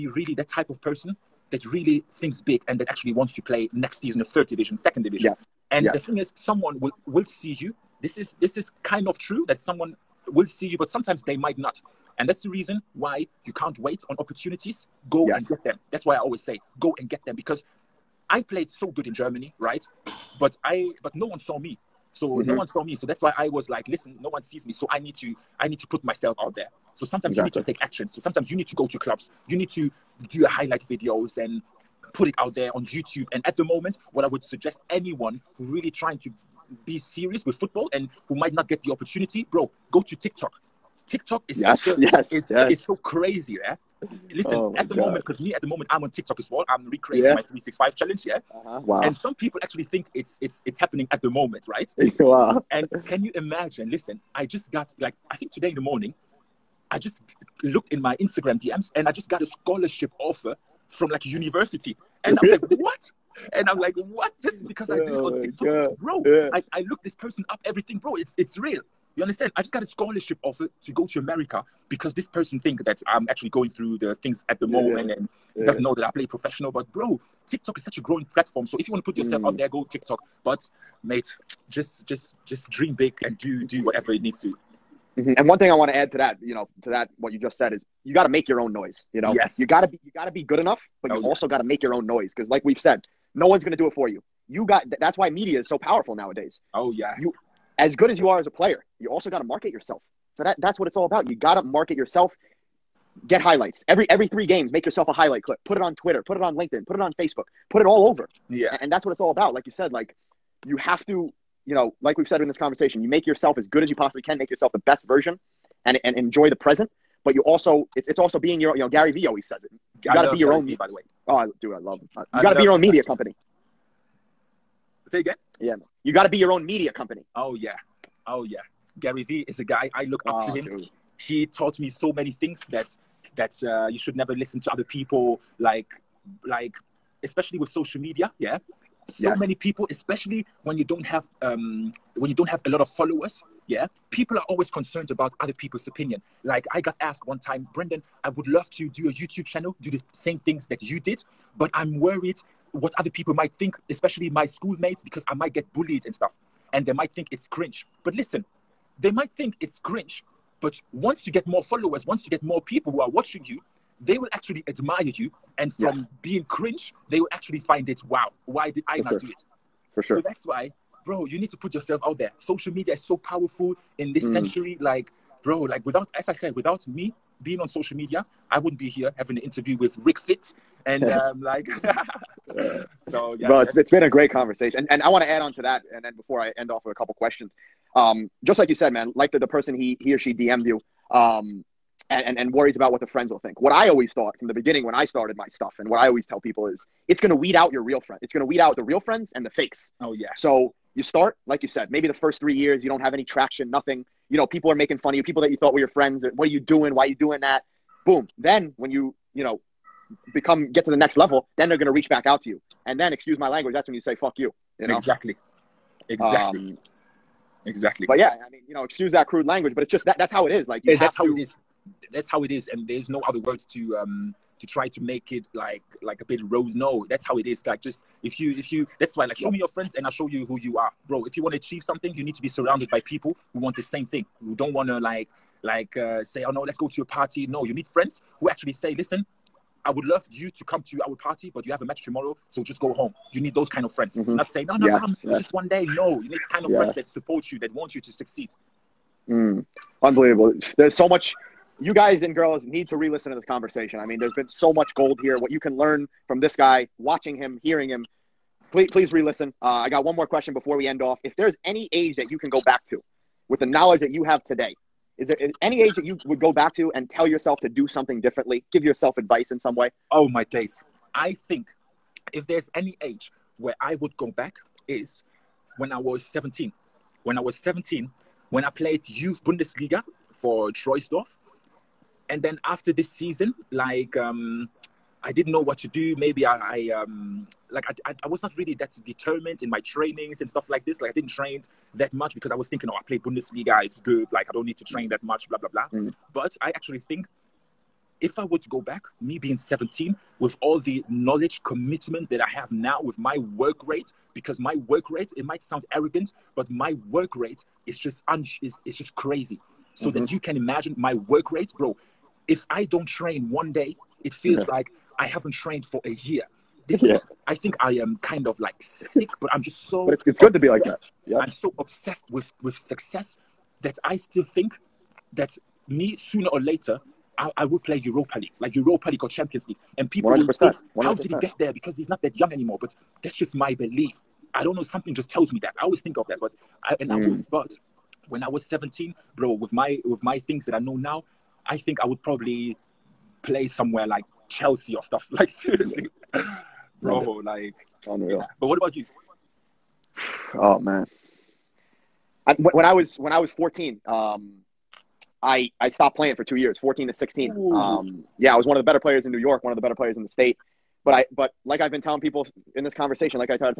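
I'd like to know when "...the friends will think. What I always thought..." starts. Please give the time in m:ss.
3:13.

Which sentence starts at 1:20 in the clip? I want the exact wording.
But mate, just just just dream big and do do whatever it needs to.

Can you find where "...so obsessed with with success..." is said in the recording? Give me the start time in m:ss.
5:21.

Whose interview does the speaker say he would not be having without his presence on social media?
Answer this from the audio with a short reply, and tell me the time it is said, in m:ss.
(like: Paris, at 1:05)
RicFit, at 3:00.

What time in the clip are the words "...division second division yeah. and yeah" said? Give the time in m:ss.
0:04.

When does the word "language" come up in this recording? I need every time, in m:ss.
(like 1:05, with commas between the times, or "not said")
3:33, 3:39.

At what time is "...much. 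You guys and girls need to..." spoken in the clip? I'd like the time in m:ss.
4:11.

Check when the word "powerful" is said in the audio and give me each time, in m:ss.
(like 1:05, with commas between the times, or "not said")
1:35, 2:53.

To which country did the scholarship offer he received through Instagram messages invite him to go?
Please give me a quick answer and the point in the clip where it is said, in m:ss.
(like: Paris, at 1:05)
America, at 1:11.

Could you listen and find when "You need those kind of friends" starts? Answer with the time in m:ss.
4:03.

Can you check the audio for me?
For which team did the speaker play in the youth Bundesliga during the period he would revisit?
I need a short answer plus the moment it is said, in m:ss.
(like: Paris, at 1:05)
Troisdorf, at 4:40.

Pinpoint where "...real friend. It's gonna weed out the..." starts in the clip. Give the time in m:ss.
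3:17.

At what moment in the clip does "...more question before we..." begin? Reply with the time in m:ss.
4:20.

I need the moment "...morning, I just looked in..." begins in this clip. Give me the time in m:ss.
0:55.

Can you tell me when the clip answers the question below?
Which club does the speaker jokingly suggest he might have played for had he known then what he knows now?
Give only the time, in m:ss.
5:44.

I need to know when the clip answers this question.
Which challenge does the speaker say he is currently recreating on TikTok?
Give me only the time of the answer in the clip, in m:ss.
0:47.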